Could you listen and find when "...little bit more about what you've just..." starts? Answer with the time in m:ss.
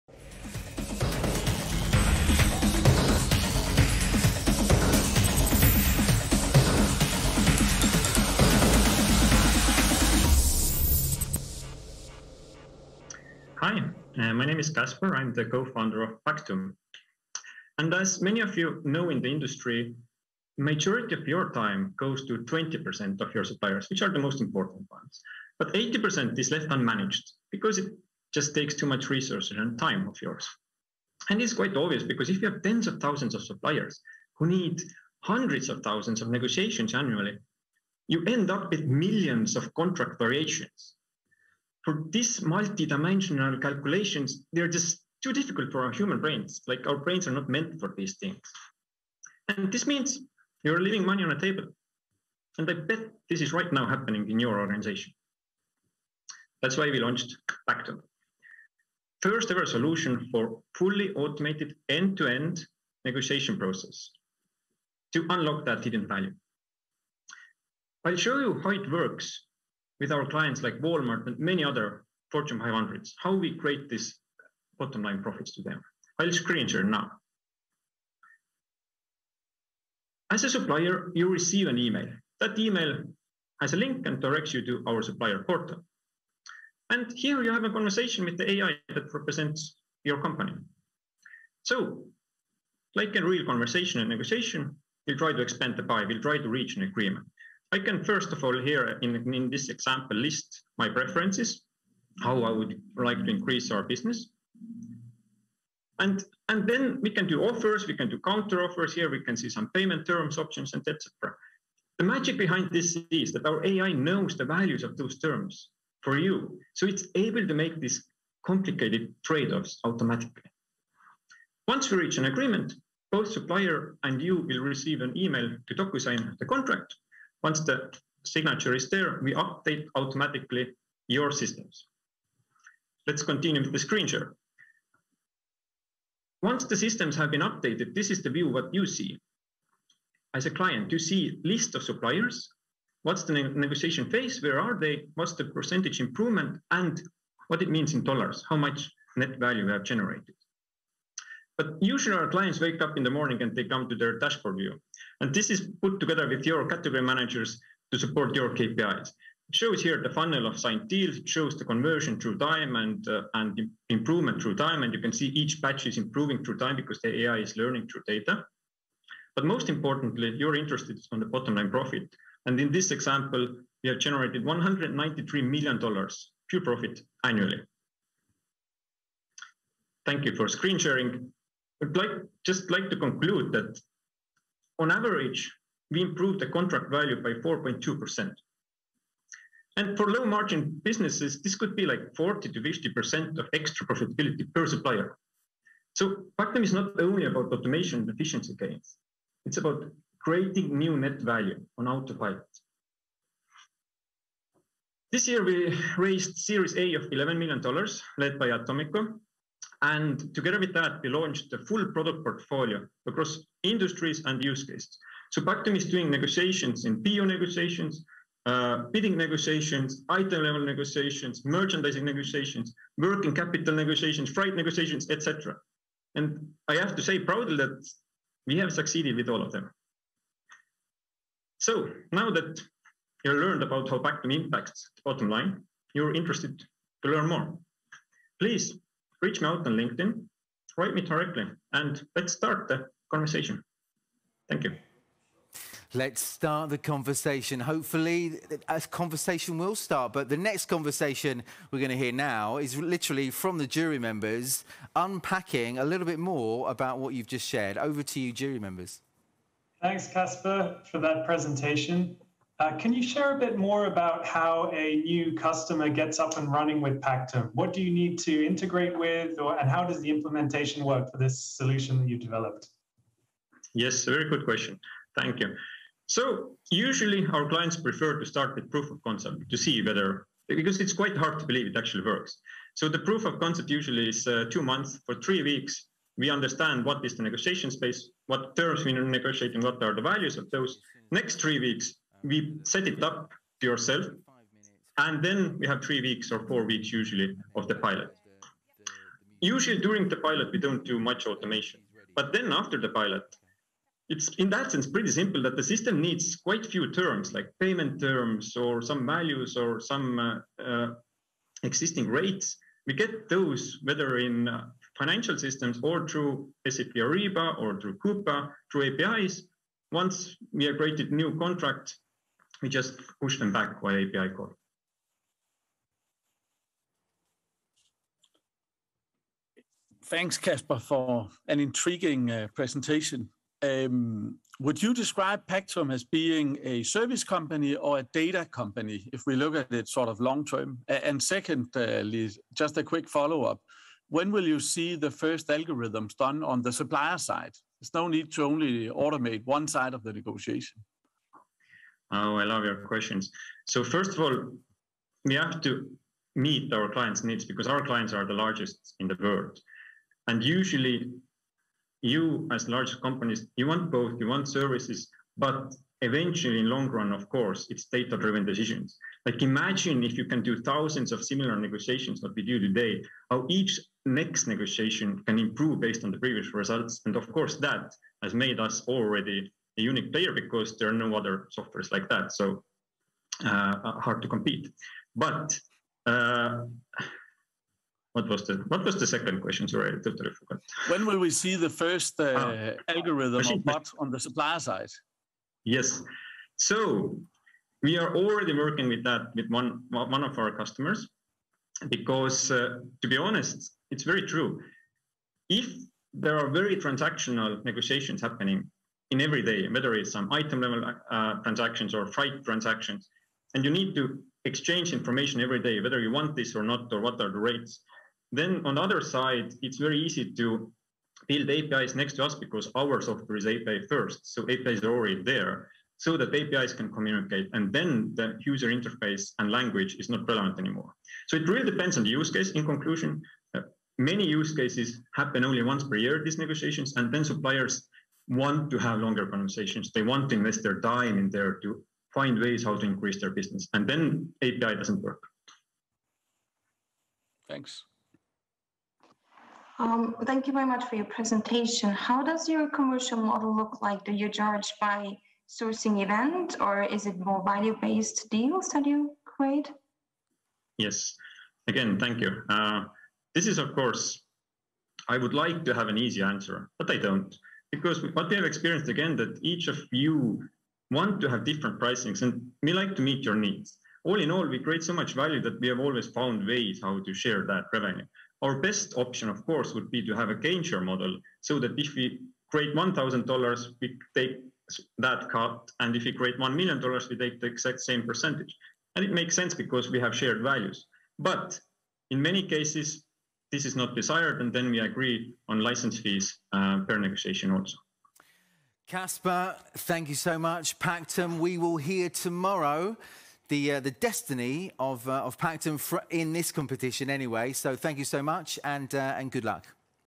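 4:15.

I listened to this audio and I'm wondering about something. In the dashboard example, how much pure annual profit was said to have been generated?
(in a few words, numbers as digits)
$193 million.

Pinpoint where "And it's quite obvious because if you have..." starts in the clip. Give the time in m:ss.
0:31.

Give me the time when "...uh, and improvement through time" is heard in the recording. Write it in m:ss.
2:43.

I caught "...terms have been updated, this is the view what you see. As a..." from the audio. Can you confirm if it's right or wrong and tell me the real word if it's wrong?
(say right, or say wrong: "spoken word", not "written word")
wrong: "systems", not "terms".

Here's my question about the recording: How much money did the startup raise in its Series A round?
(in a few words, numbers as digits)
$11 million.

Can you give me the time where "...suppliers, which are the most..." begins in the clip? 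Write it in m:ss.
0:23.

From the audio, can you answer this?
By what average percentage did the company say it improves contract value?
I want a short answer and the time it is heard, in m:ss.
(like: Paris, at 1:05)
4.2%, at 3:07.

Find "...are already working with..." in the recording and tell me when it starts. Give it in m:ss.
6:37.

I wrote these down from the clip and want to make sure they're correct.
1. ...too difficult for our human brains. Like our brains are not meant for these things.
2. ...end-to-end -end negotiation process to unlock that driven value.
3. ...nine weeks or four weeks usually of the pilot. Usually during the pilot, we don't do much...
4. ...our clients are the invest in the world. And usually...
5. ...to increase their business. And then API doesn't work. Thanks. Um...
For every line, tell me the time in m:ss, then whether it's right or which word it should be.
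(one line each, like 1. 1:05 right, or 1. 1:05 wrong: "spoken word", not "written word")
1. 0:45 right
2. 1:01 wrong: "hidden", not "driven"
3. 4:55 wrong: "three", not "nine"
4. 5:57 wrong: "largest", not "invest"
5. 7:22 right.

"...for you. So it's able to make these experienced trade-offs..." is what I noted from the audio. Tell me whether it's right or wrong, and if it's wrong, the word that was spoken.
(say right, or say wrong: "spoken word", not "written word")
wrong: "complicated", not "experienced".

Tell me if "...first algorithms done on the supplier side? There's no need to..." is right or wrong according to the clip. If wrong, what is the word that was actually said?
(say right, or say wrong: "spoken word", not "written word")
right.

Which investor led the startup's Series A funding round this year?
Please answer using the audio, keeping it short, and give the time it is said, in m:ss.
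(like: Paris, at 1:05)
Atomico, at 3:28.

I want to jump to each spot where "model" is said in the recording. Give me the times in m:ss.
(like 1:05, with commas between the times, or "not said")
7:33, 8:00.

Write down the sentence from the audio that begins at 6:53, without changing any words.
And you need to exchange information every day, whether you want this or not, or what are the rates.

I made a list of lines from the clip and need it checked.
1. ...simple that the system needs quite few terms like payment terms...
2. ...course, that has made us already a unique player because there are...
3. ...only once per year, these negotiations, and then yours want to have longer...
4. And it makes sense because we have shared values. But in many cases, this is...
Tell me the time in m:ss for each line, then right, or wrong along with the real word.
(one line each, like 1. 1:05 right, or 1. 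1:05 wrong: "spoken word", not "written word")
1. 5:05 right
2. 6:17 right
3. 7:15 wrong: "suppliers", not "yours"
4. 8:08 right.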